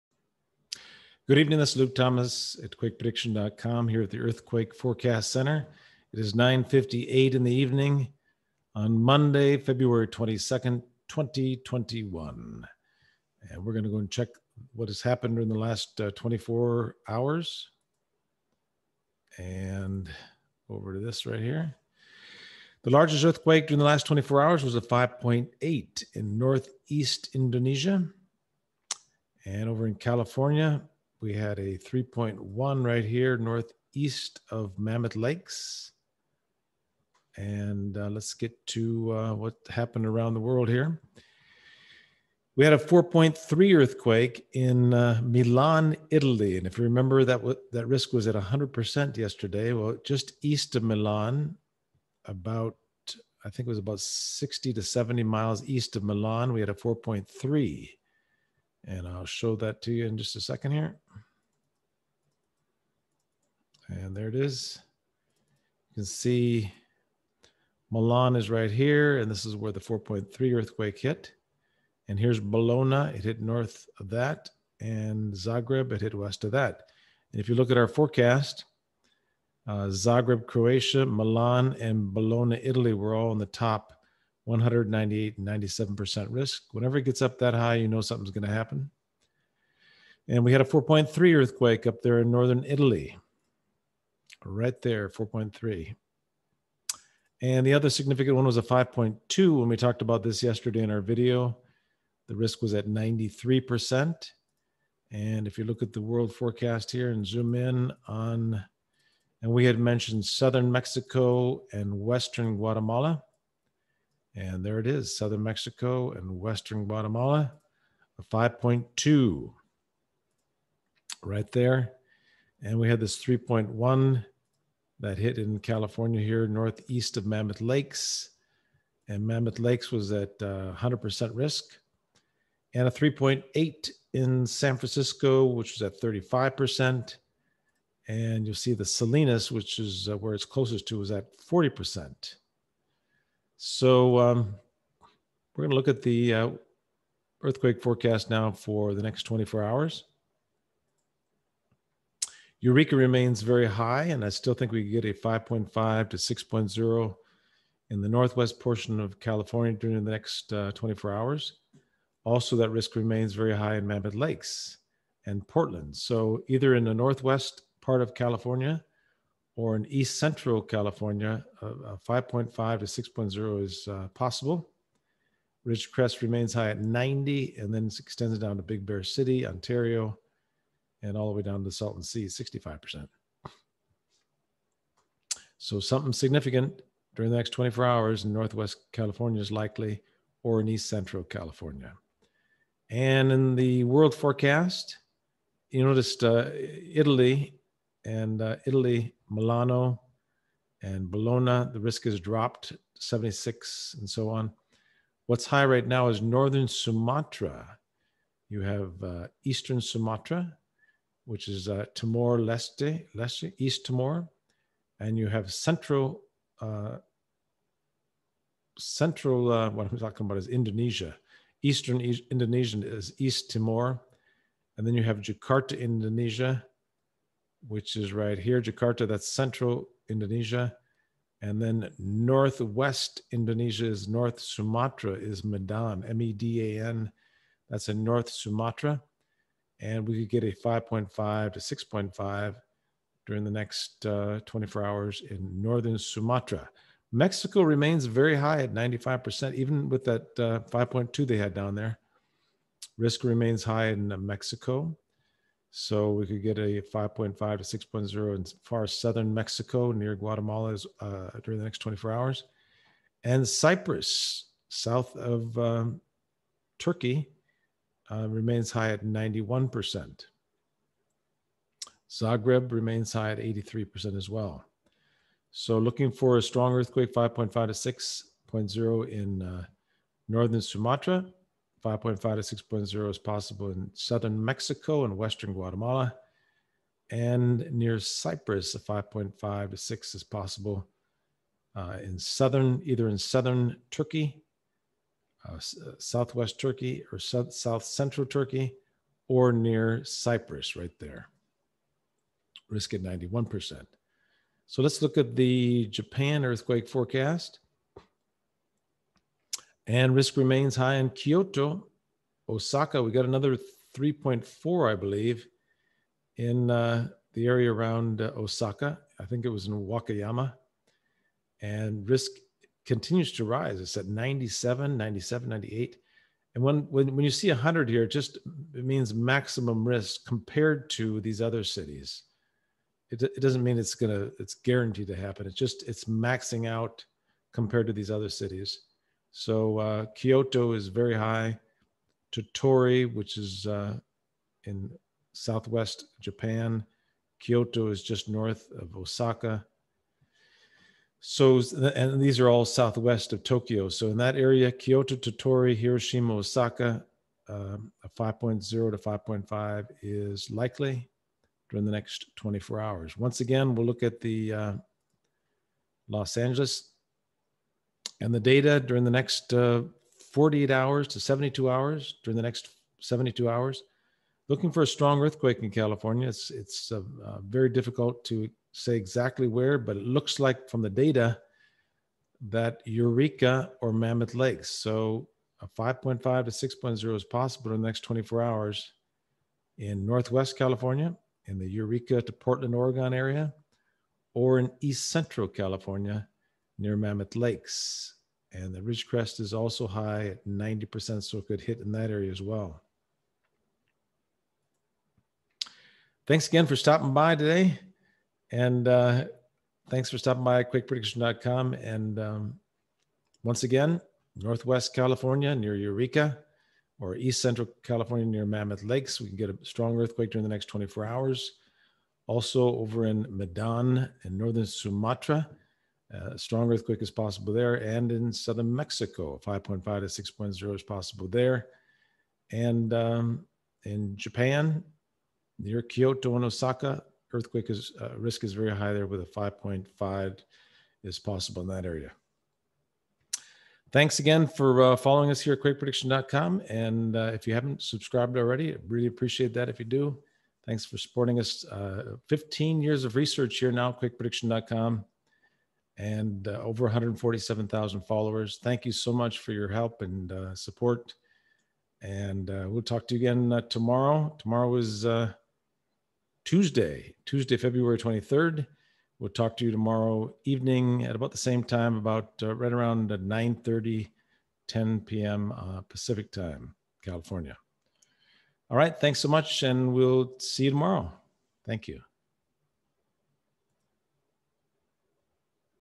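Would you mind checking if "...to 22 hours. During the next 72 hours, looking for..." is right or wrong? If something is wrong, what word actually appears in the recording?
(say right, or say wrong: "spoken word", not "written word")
wrong: "72", not "22".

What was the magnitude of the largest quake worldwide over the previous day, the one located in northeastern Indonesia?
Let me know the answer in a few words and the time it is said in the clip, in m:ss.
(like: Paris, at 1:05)
5.8, at 0:24.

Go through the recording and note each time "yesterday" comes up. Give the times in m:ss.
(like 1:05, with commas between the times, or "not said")
0:49, 1:40.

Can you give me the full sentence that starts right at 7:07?
And in southern Mexico, 5.5 to 6.0 is possible there.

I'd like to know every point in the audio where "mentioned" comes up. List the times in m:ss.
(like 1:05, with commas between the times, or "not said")
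1:49.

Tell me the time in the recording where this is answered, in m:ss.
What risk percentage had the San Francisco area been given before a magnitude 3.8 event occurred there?
2:15.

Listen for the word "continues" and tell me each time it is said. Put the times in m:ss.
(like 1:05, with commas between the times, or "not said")
5:22.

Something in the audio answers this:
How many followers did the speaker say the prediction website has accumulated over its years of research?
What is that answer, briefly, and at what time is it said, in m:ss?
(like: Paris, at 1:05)
147,000, at 7:36.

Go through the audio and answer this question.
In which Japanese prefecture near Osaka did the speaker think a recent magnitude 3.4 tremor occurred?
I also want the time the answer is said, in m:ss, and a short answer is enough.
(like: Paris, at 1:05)
Wakayama, at 5:19.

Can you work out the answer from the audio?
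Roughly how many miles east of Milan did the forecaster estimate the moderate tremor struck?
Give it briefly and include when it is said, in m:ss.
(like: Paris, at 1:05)
60 to 70, at 0:53.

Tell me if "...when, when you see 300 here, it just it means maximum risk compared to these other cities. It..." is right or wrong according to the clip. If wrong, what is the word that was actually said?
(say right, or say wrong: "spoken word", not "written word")
wrong: "100", not "300".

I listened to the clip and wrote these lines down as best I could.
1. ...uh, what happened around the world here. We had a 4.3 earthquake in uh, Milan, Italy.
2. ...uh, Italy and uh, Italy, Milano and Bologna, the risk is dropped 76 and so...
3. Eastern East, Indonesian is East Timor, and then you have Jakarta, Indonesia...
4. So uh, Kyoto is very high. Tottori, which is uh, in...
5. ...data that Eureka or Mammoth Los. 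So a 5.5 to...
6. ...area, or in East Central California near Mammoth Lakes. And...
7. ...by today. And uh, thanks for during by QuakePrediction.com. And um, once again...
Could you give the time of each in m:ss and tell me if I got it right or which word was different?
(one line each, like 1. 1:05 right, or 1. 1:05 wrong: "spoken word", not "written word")
1. 0:39 right
2. 3:16 right
3. 3:41 right
4. 5:39 right
5. 6:20 wrong: "Lakes", not "Los"
6. 6:33 right
7. 6:47 wrong: "stopping", not "during".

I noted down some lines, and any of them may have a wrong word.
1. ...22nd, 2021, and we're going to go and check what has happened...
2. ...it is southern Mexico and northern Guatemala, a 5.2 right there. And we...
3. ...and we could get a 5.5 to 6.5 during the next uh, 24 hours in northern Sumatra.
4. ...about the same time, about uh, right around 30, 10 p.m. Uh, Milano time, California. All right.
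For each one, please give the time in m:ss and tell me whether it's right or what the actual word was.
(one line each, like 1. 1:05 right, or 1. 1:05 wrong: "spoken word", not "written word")
1. 0:10 right
2. 1:54 wrong: "western", not "northern"
3. 3:59 right
4. 7:51 wrong: "Pacific", not "Milano".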